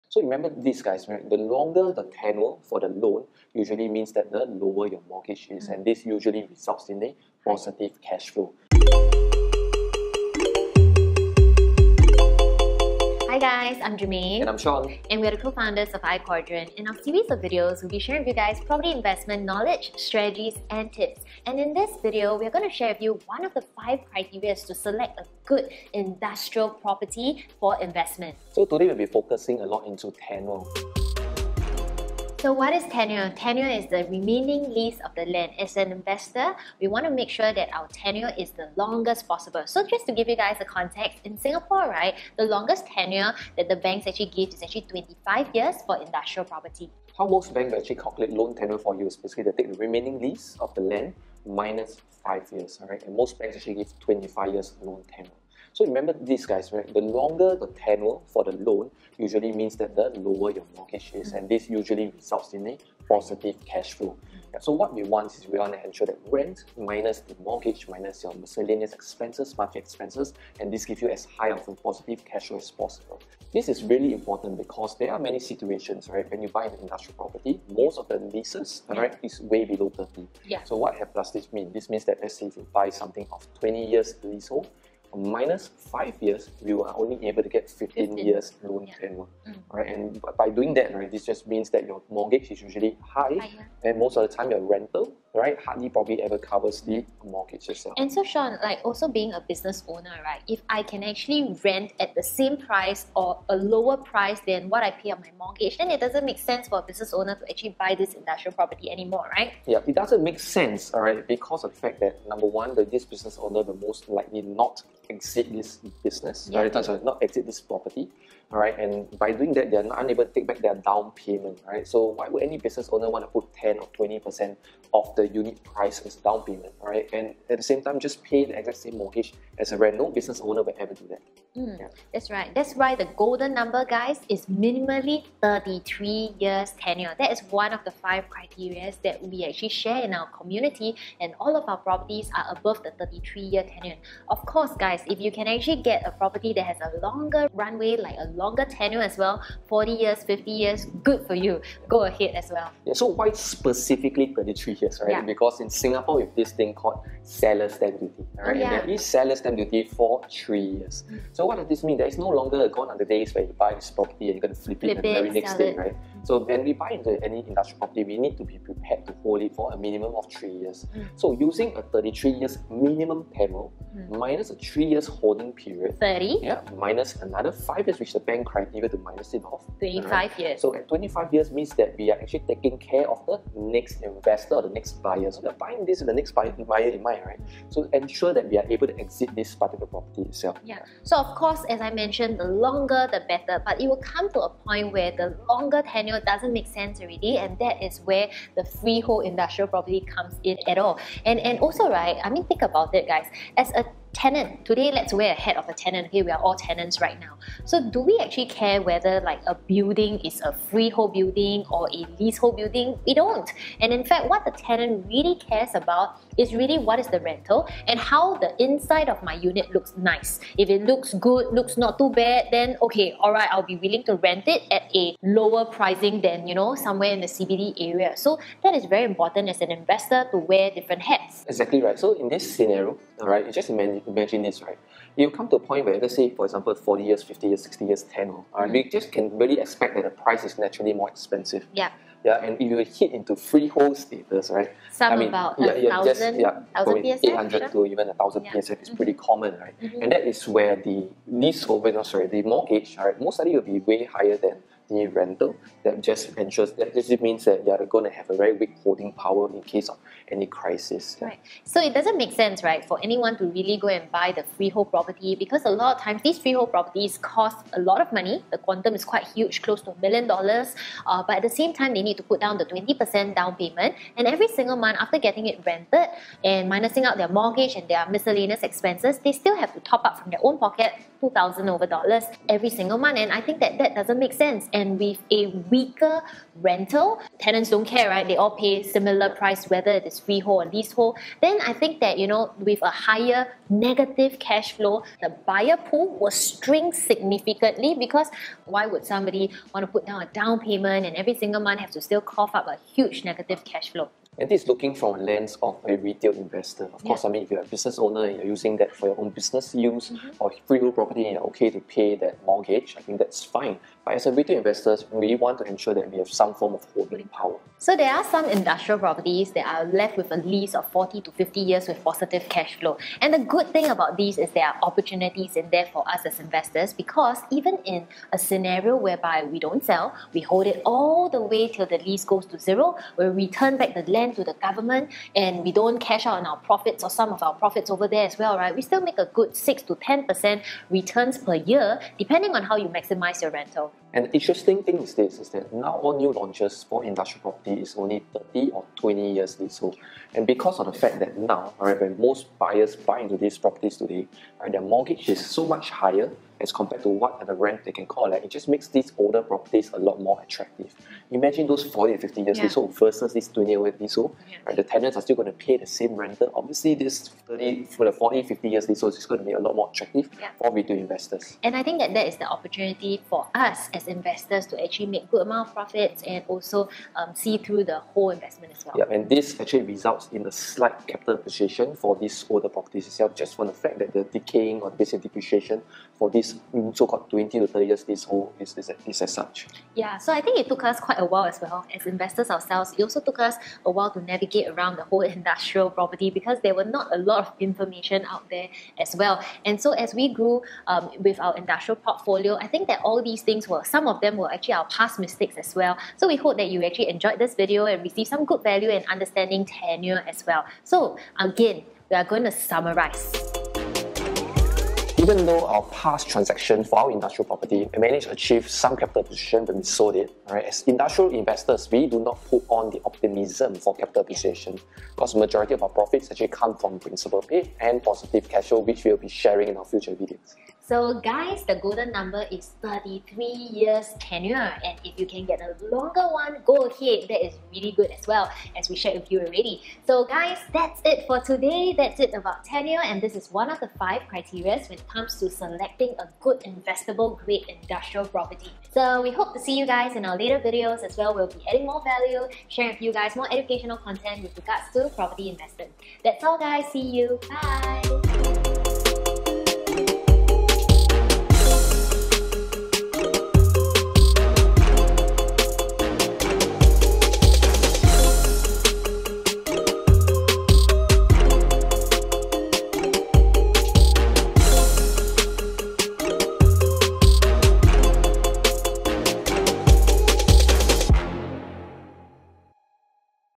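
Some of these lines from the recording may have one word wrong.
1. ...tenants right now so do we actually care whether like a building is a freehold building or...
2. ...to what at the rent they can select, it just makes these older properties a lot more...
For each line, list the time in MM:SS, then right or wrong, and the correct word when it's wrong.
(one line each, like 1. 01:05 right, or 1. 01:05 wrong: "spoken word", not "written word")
1. 03:26 right
2. 05:57 wrong: "collect", not "select".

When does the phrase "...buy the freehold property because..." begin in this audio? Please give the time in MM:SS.
04:24.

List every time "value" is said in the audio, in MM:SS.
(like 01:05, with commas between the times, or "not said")
06:48, 07:32.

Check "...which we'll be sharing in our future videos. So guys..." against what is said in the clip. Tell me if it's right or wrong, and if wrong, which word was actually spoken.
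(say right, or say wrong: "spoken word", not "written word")
right.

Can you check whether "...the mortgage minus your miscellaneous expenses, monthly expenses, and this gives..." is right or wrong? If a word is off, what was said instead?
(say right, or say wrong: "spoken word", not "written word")
right.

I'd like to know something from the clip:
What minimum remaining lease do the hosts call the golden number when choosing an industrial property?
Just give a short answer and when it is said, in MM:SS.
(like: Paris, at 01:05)
33 years, at 02:14.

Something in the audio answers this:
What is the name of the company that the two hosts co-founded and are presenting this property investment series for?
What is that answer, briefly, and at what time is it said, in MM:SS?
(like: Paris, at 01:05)
iQuadrant, at 00:16.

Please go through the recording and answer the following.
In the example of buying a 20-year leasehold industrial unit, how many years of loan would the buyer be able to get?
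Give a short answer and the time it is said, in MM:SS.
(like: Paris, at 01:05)
15 years, at 01:27.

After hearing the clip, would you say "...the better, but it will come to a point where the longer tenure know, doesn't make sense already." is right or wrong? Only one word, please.
right.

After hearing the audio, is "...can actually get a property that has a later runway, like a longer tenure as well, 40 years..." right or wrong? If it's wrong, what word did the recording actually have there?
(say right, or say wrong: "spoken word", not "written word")
wrong: "longer", not "later".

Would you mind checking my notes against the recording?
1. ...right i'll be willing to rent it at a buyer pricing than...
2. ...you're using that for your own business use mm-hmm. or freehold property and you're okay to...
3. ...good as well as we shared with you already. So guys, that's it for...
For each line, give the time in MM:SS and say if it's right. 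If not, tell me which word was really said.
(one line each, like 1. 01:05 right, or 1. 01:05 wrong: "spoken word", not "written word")
1. 03:43 wrong: "lower", not "buyer"
2. 05:08 right
3. 07:17 right.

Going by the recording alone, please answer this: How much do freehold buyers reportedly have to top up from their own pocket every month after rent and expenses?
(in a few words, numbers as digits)
2000 dollars.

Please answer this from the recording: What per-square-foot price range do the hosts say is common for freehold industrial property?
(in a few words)
800 to 1000 PSF.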